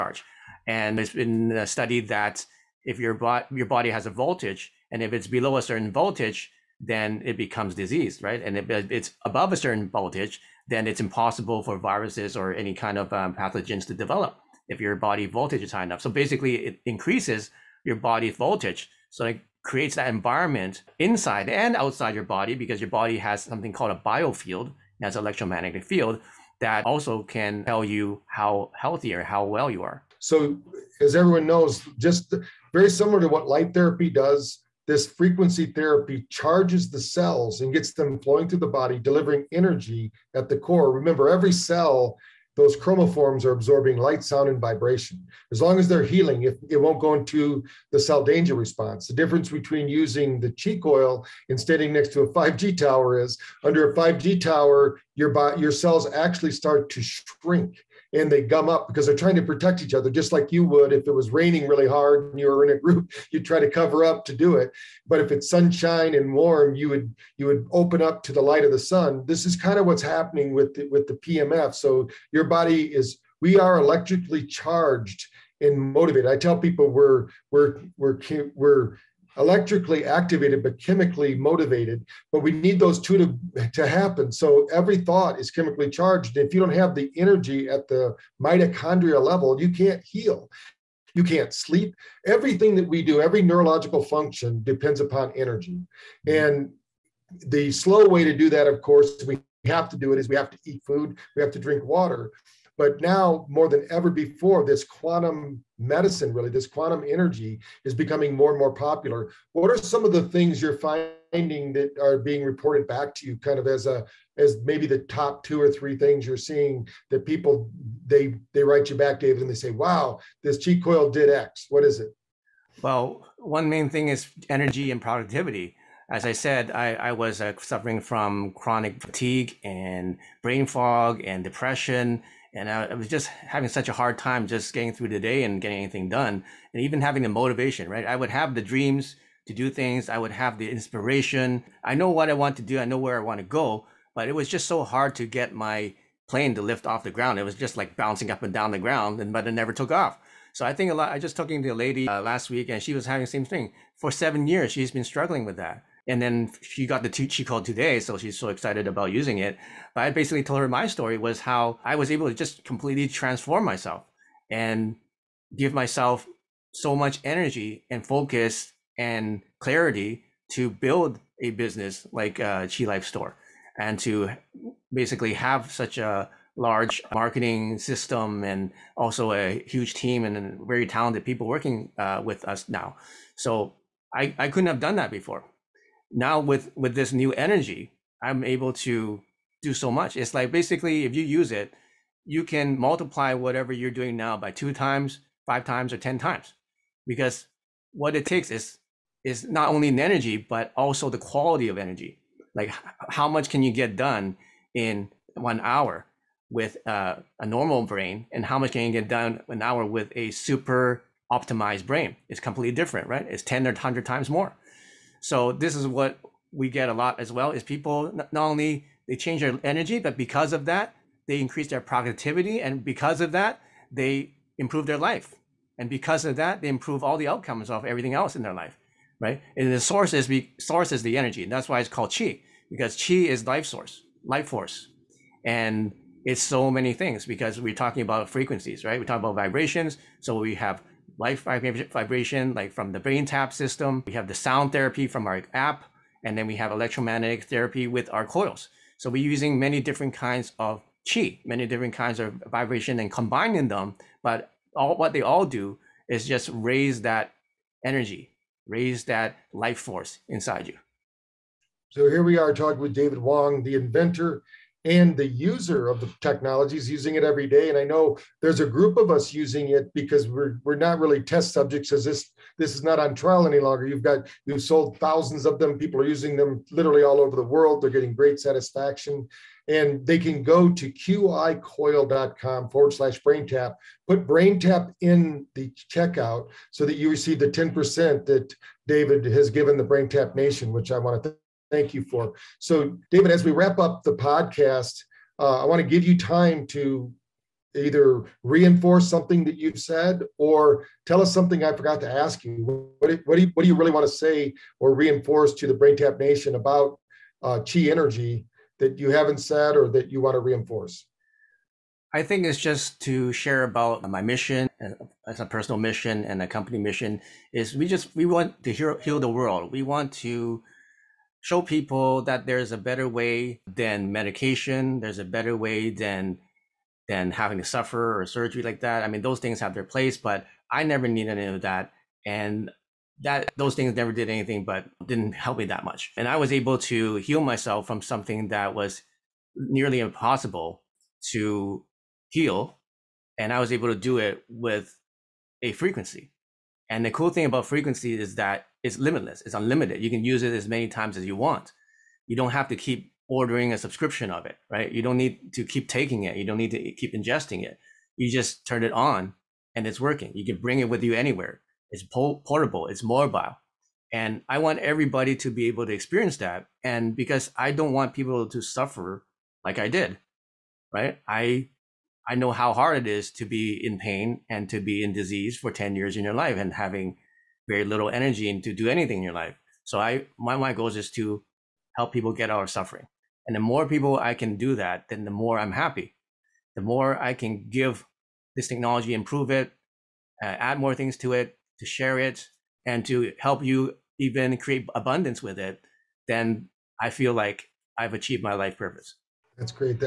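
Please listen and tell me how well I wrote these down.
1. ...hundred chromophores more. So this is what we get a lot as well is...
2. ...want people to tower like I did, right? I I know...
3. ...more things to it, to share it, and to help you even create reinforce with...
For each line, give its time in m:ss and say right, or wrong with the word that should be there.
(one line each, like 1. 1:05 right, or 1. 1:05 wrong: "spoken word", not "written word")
1. 3:33 wrong: "times", not "chromophores"
2. 6:07 wrong: "suffer", not "tower"
3. 6:30 wrong: "abundance", not "reinforce".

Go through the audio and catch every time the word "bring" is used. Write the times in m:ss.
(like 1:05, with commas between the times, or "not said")
6:00.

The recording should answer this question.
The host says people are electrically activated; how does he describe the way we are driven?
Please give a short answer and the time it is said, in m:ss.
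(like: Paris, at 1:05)
chemically motivated, at 1:20.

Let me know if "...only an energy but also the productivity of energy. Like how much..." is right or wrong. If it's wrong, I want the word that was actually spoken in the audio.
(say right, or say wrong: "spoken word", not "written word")
wrong: "quality", not "productivity".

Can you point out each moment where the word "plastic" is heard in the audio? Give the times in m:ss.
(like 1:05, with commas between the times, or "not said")
not said.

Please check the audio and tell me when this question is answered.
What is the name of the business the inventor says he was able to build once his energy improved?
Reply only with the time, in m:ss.
2:52.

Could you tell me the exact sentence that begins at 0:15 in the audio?
So basically, it increases your body voltage.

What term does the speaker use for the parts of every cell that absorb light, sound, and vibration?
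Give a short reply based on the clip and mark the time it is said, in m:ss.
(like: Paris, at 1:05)
chromophores, at 0:42.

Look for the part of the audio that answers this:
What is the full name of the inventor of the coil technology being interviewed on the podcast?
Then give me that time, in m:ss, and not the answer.
4:22.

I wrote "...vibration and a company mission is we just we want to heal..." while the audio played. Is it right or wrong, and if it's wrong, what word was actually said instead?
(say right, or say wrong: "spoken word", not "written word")
wrong: "mission", not "vibration".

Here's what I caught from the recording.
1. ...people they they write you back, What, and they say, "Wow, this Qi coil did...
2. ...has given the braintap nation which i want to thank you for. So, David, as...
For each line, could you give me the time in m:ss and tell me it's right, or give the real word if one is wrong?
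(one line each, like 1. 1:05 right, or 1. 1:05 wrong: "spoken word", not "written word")
1. 1:57 wrong: "David", not "What"
2. 4:49 right.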